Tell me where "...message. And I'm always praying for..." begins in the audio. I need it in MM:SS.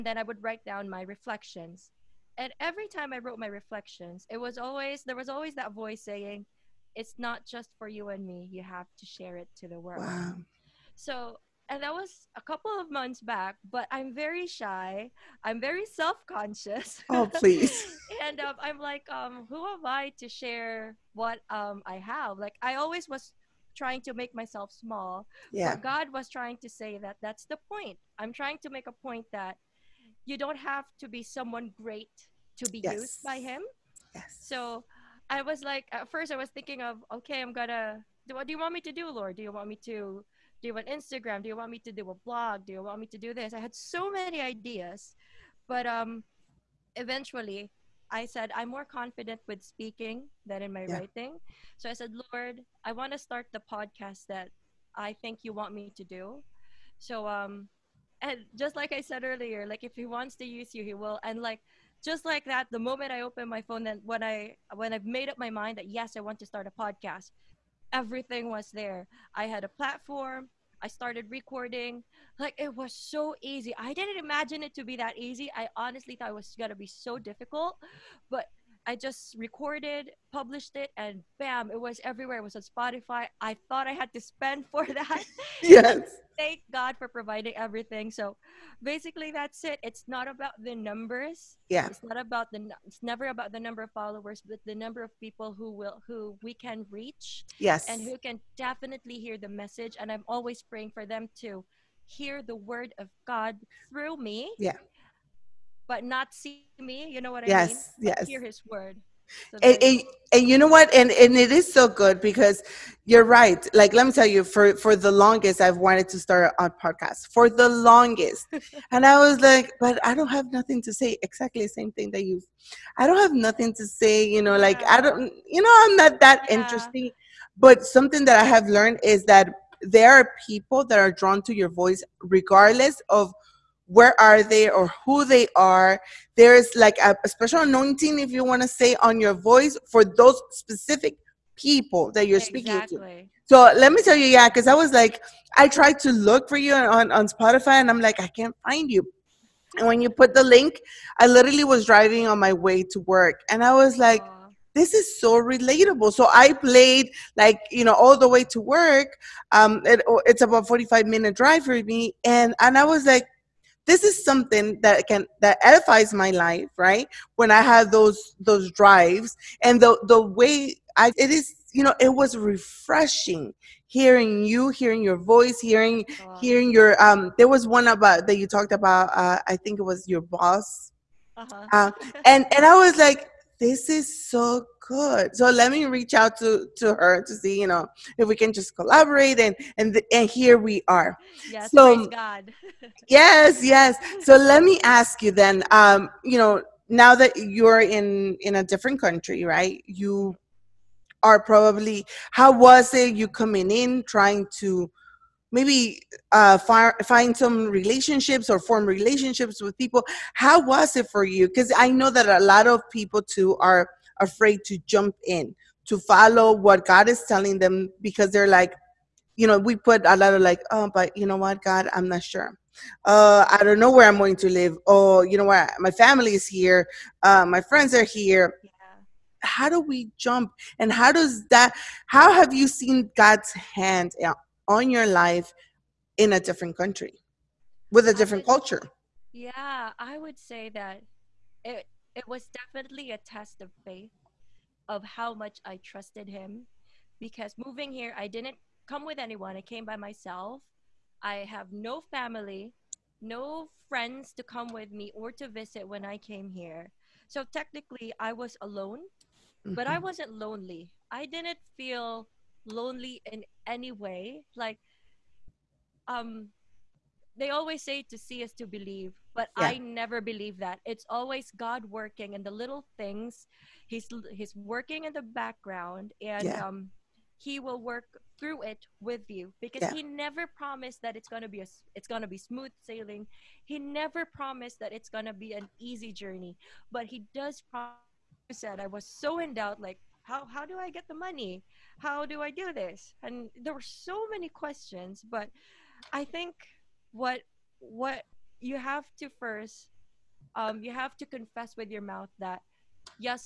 01:39.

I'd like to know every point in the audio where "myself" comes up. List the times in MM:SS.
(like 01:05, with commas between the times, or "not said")
00:24, 04:09.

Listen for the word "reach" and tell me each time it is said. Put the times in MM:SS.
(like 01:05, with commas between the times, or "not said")
01:36, 03:05.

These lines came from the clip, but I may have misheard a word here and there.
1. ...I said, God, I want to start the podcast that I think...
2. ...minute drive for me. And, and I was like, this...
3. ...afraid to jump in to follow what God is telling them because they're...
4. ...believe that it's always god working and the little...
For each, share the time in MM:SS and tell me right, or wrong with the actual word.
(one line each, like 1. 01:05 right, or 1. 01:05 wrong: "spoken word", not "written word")
1. 00:51 wrong: "Lord", not "God"
2. 02:41 right
3. 03:34 right
4. 04:30 right.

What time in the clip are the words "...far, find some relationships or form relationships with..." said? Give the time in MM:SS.
03:26.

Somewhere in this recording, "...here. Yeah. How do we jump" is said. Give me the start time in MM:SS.
03:48.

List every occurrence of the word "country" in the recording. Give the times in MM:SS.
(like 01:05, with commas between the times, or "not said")
03:18, 03:56.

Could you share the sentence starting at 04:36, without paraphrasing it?
um he will work through it with you because yeah.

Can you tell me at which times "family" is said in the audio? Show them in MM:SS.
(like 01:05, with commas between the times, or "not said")
03:45, 04:12.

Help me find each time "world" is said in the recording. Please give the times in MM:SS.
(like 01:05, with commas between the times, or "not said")
00:09.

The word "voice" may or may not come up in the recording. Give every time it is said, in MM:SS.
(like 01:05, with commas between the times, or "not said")
00:05, 02:11, 02:19, 02:55.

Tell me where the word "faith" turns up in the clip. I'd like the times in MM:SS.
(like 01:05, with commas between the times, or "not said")
04:03.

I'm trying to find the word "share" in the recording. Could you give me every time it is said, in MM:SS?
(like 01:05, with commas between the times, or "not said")
00:09, 00:20.